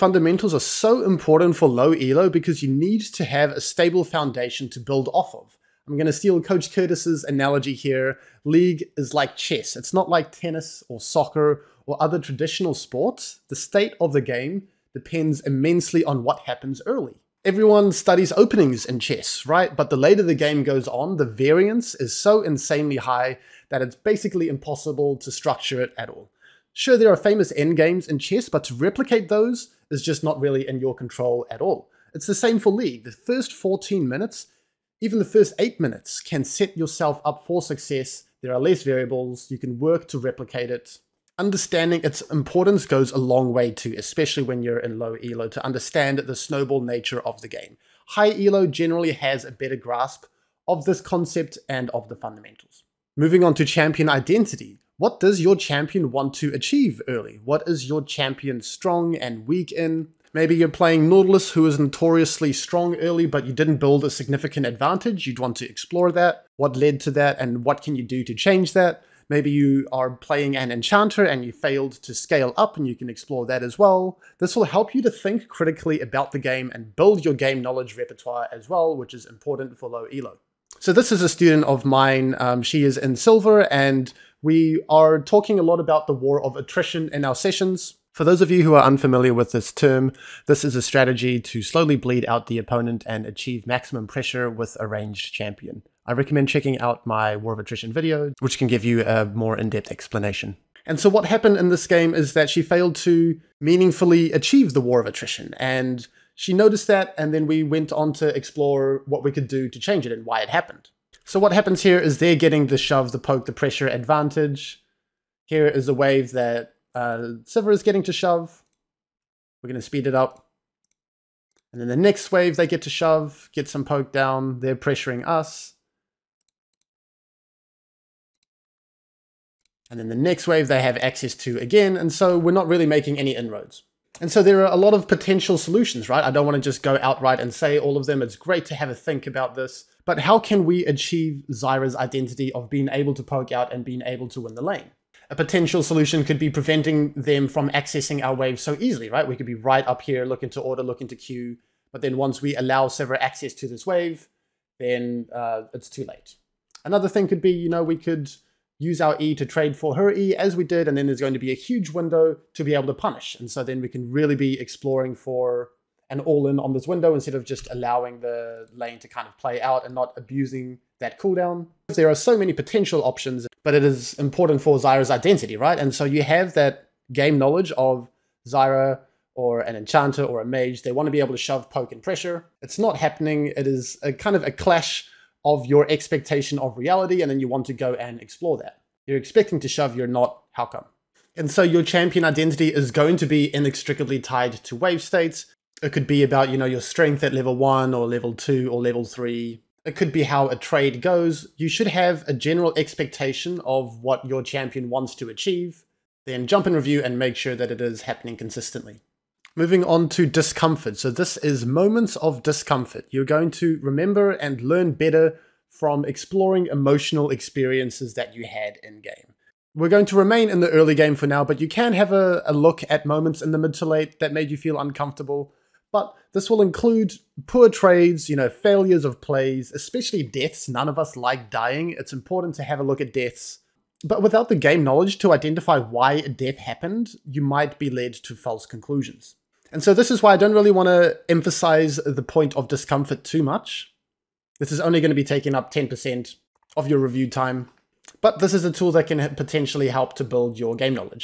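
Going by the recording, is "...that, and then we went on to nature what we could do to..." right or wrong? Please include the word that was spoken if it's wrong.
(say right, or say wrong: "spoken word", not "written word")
wrong: "explore", not "nature".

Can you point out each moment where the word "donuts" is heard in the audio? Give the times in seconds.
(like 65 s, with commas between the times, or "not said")
not said.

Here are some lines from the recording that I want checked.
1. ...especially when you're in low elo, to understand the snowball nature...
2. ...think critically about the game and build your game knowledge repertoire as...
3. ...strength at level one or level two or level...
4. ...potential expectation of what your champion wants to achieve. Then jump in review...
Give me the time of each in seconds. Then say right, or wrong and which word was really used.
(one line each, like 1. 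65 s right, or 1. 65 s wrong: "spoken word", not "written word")
1. 43 s right
2. 75 s right
3. 196 s right
4. 202 s wrong: "general", not "potential".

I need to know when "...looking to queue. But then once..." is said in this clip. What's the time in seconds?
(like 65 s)
150 s.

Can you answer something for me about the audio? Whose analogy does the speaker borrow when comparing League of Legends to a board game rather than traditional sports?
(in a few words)
Coach Curtis.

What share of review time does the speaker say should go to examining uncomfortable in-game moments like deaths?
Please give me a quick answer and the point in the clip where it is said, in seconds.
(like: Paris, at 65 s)
10%, at 245 s.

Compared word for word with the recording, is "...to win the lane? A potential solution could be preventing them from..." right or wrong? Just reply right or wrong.
right.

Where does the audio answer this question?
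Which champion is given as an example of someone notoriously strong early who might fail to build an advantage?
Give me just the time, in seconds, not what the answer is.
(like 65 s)
61 s.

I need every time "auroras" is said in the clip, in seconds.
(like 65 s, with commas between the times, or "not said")
not said.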